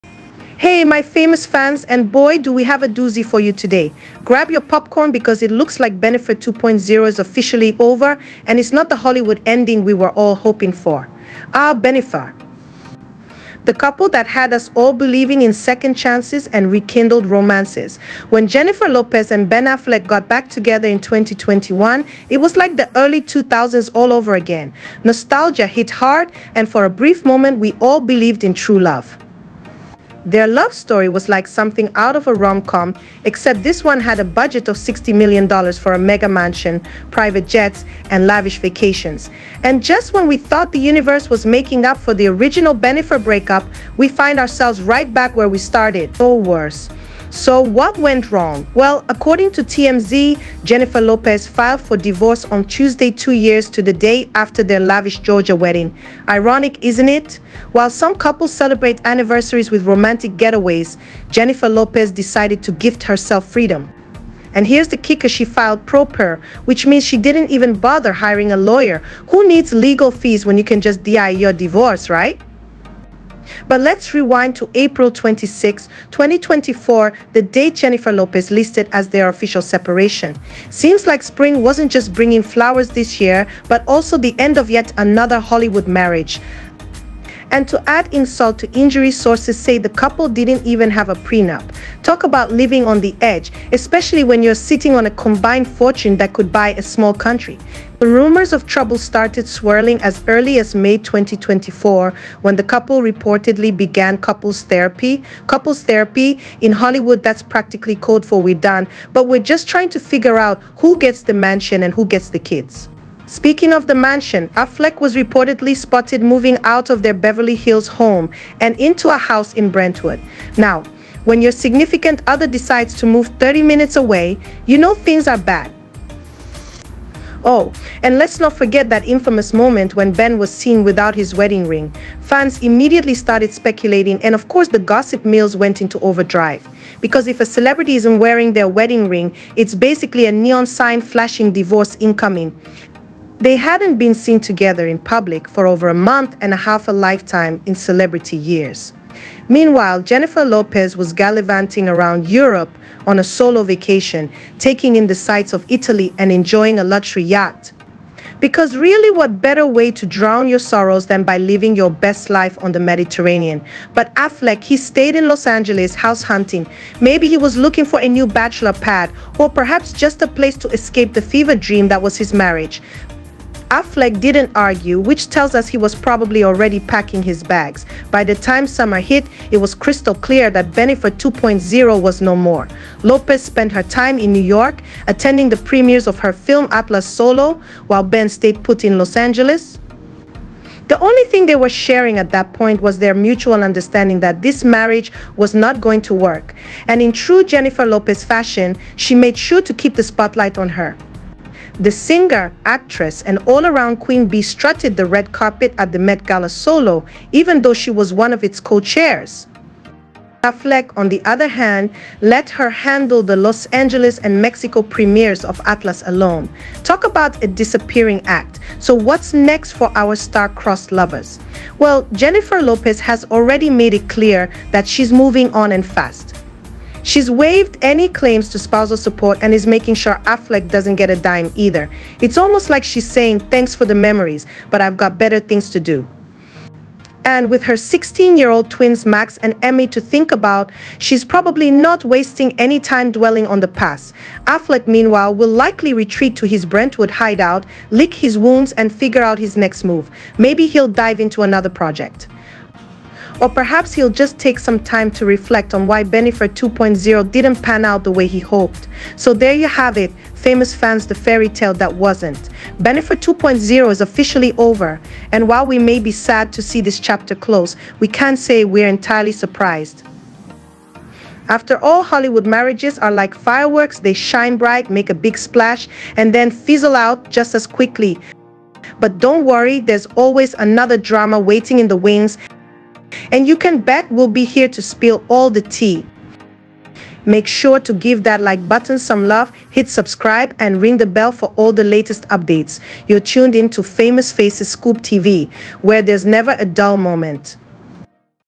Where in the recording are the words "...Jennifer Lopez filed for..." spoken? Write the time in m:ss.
0:50.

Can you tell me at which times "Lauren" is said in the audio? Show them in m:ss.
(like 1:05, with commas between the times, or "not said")
not said.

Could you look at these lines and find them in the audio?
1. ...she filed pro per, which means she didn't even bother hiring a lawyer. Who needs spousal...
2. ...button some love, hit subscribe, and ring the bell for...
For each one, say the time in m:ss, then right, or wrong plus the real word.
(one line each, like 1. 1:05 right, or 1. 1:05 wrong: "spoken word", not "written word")
1. 1:05 wrong: "legal", not "spousal"
2. 4:48 right.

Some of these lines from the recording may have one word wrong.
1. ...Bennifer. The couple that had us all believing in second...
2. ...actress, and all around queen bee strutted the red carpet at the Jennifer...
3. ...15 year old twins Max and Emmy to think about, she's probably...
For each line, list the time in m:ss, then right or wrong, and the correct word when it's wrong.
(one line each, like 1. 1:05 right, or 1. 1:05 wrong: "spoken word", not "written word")
1. 0:11 right
2. 3:22 wrong: "Met", not "Jennifer"
3. 3:57 wrong: "16", not "15".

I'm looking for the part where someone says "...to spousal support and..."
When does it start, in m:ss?
3:48.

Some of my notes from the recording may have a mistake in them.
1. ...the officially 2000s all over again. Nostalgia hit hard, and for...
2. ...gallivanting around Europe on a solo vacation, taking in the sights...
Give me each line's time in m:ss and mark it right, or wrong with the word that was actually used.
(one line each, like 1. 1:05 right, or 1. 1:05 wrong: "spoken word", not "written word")
1. 0:22 wrong: "early", not "officially"
2. 2:31 right.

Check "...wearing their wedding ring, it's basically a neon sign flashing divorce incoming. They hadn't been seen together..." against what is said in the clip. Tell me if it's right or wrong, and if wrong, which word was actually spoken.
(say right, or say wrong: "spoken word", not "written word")
right.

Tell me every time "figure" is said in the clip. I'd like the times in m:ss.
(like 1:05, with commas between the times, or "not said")
1:49, 4:08.